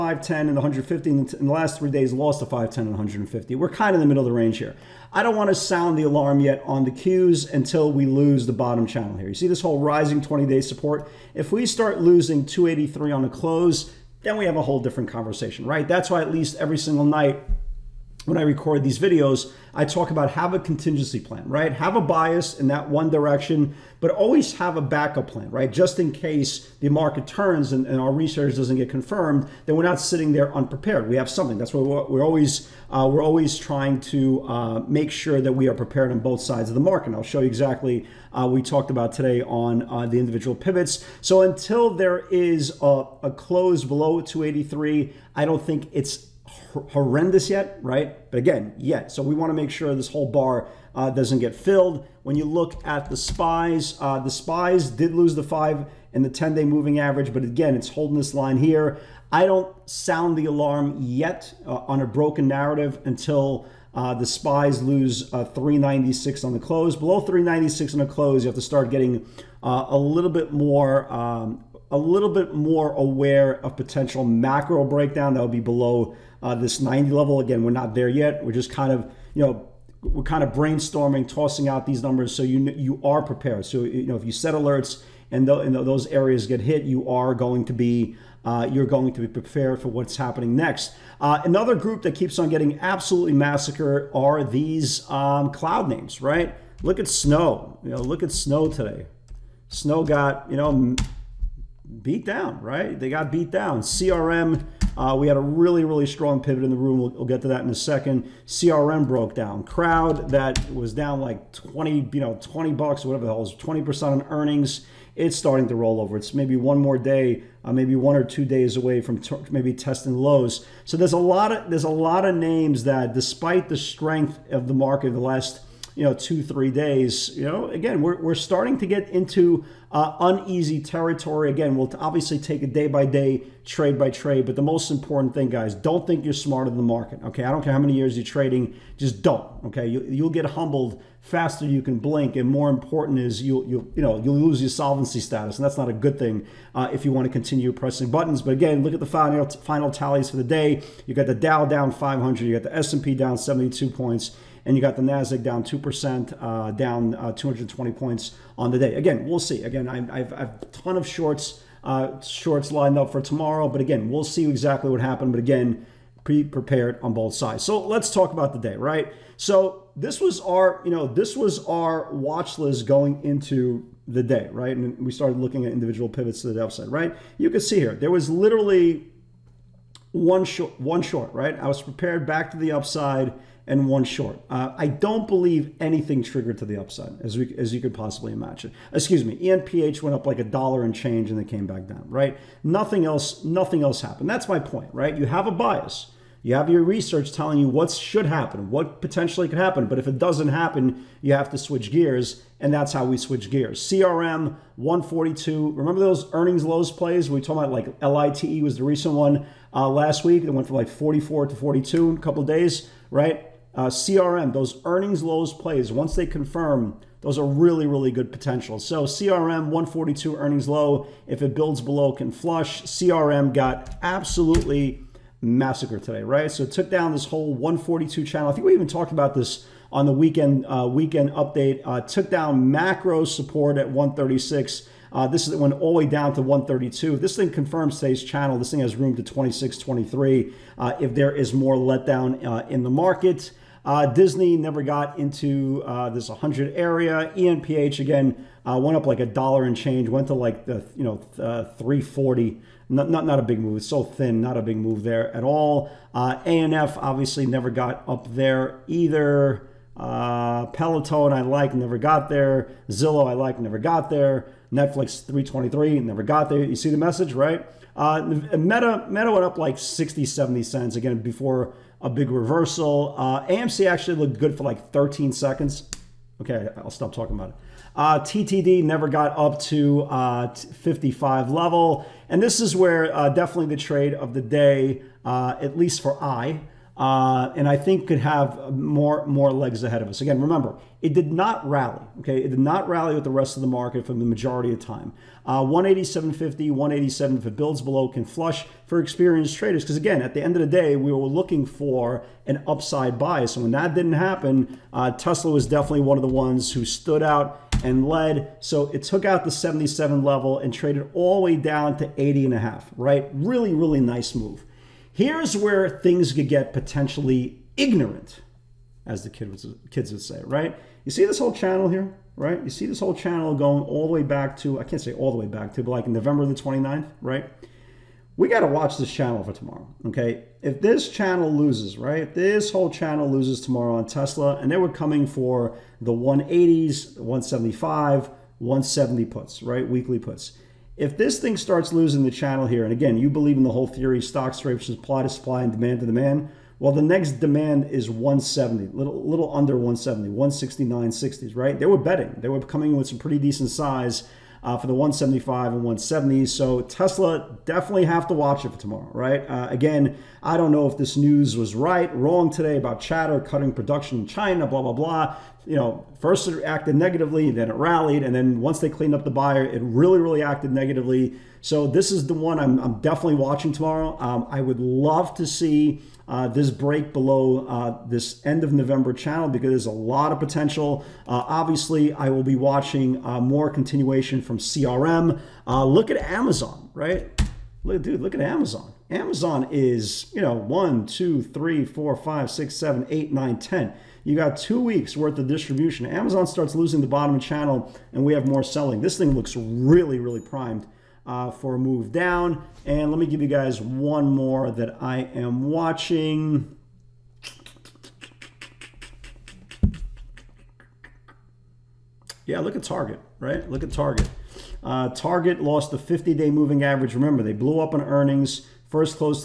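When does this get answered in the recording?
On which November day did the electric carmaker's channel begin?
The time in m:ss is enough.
5:26.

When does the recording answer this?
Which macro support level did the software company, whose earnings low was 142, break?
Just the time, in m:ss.
3:53.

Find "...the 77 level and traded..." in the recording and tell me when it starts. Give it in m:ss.
5:09.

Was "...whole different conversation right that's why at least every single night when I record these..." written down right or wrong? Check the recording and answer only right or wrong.
right.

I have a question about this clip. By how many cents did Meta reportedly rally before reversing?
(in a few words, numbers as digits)
60, 70 cents.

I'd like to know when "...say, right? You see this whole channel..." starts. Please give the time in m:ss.
5:20.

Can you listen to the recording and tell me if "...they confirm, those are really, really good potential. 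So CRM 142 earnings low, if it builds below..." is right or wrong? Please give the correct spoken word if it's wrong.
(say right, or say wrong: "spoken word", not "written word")
right.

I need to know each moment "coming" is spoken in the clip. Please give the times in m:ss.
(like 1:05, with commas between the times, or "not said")
5:34, 5:52.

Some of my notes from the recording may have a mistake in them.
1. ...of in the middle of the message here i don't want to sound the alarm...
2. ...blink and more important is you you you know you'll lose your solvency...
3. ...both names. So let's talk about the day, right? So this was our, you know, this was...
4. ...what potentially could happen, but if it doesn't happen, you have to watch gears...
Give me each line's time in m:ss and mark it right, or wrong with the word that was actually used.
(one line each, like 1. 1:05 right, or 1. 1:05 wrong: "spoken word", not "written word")
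1. 0:03 wrong: "range", not "message"
2. 2:21 right
3. 2:47 wrong: "sides", not "names"
4. 3:18 wrong: "switch", not "watch".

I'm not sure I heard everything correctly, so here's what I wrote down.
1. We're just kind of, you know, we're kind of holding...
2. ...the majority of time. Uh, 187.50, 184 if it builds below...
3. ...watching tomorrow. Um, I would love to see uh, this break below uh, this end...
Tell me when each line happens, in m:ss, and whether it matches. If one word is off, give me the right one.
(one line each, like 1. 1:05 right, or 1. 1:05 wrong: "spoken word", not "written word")
1. 1:18 wrong: "brainstorming", not "holding"
2. 4:54 wrong: "187", not "184"
3. 6:13 right.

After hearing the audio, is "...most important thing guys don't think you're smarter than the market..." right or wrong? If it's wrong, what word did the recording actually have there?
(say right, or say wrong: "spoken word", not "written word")
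right.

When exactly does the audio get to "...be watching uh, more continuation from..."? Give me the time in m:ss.
6:22.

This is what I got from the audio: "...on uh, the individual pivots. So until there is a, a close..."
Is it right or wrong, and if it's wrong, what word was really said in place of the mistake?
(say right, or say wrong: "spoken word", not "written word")
right.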